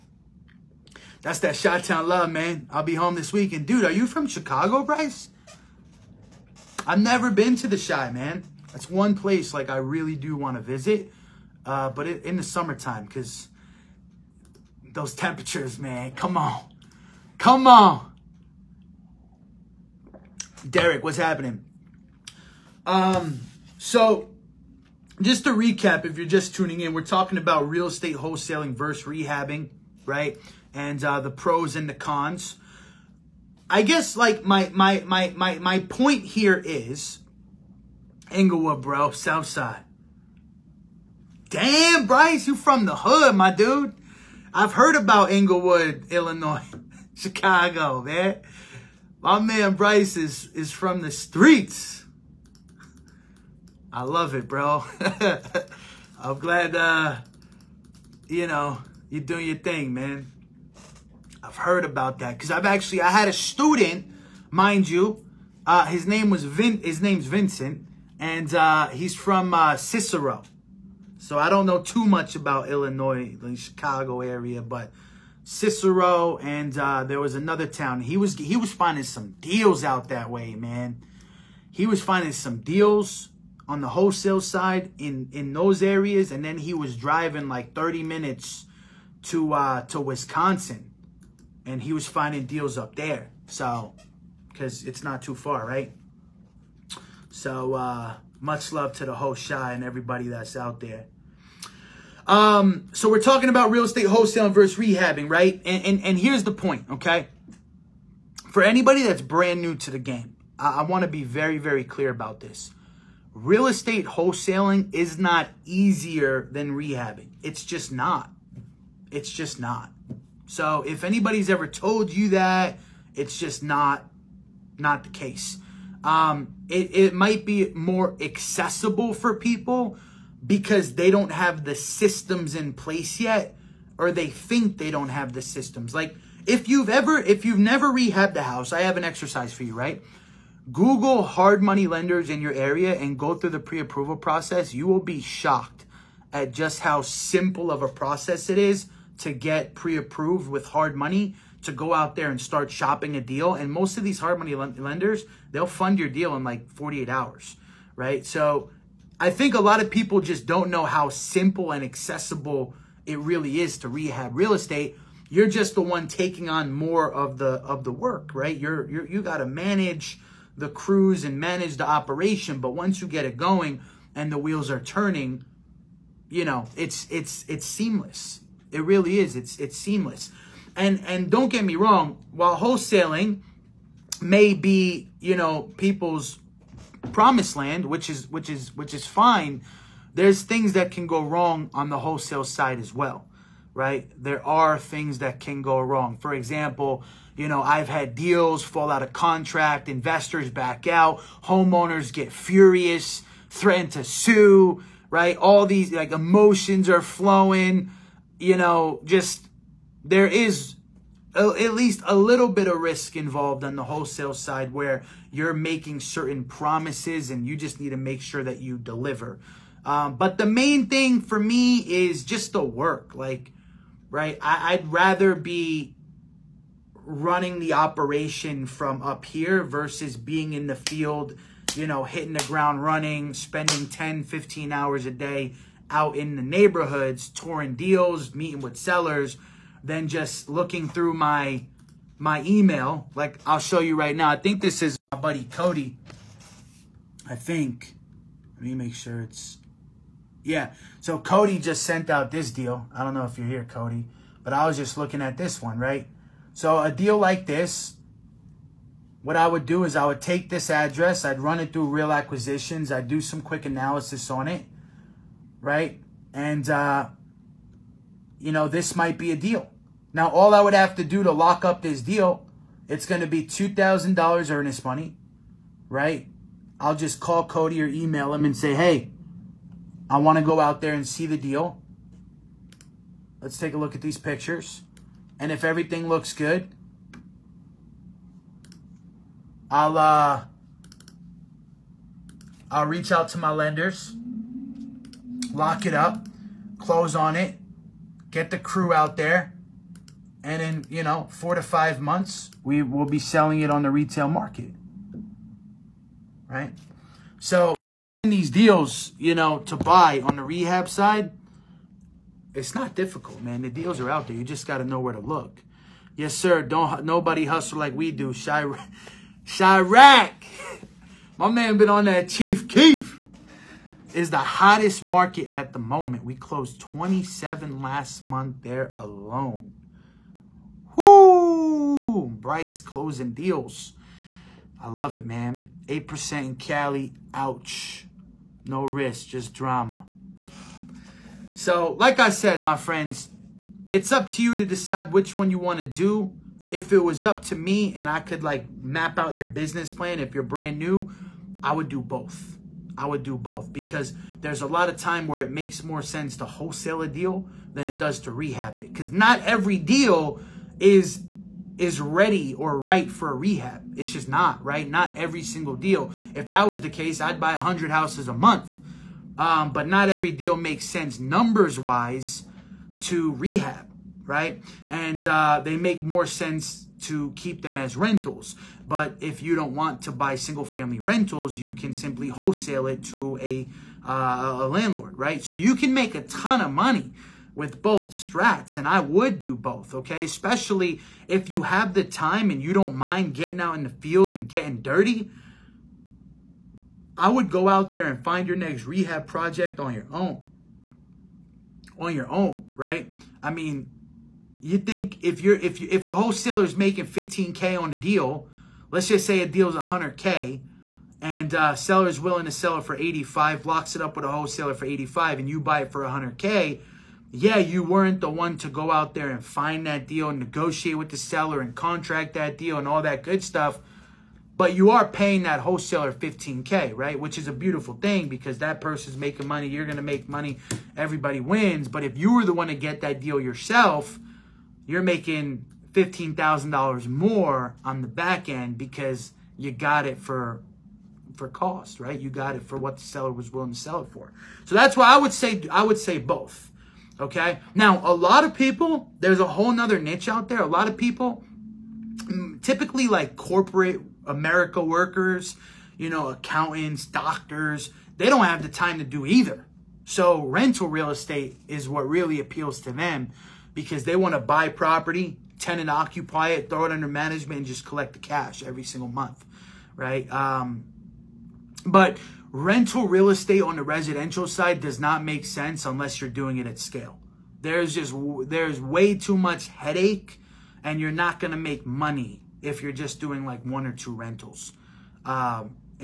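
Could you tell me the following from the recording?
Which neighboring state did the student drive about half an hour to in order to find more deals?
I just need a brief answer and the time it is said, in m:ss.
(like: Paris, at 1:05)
Wisconsin, at 1:29.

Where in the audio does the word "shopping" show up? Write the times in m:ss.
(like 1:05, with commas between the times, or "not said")
2:32.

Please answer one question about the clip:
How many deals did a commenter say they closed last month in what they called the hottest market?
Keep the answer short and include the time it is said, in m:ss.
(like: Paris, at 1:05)
27, at 5:26.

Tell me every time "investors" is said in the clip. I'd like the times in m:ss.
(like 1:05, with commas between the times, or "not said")
3:19.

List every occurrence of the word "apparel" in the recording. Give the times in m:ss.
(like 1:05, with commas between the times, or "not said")
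not said.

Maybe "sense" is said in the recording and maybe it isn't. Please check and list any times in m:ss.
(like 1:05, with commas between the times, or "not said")
5:56, 6:10, 6:16, 7:55.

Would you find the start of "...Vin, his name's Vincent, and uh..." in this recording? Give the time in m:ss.
1:06.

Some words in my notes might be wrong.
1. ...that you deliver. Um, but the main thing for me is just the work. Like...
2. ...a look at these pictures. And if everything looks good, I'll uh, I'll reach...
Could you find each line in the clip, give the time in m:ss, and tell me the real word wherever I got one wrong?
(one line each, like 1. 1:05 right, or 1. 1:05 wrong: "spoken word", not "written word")
1. 3:38 right
2. 4:43 right.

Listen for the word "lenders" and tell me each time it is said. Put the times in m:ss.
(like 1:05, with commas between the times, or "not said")
2:21, 2:34, 4:53.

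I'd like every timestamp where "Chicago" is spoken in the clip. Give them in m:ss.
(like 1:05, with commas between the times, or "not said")
0:04, 0:47, 1:13.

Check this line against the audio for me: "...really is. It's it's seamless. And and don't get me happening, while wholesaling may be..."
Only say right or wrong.
wrong.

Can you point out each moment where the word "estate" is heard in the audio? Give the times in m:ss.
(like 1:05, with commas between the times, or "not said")
0:27, 1:43, 1:53, 2:44, 7:41, 7:53.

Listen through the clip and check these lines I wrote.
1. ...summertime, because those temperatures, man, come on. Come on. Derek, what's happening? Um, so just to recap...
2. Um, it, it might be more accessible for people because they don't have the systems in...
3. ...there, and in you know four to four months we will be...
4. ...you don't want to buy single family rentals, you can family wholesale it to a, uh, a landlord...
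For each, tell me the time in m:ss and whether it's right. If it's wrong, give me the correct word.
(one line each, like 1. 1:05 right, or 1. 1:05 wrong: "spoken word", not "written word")
1. 0:12 right
2. 2:06 right
3. 4:59 wrong: "five", not "four"
4. 6:19 wrong: "simply", not "family".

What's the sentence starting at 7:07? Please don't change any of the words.
Which is a beautiful thing because that person's making money.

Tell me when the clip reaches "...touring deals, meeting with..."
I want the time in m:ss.
3:57.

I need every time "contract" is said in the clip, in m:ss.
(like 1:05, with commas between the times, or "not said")
3:19, 7:01.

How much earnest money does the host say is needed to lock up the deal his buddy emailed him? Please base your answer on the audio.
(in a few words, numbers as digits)
$2,000.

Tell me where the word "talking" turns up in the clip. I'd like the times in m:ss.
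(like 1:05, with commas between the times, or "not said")
0:27, 1:43.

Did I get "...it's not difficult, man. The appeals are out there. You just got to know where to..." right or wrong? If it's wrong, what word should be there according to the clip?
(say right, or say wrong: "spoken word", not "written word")
wrong: "deals", not "appeals".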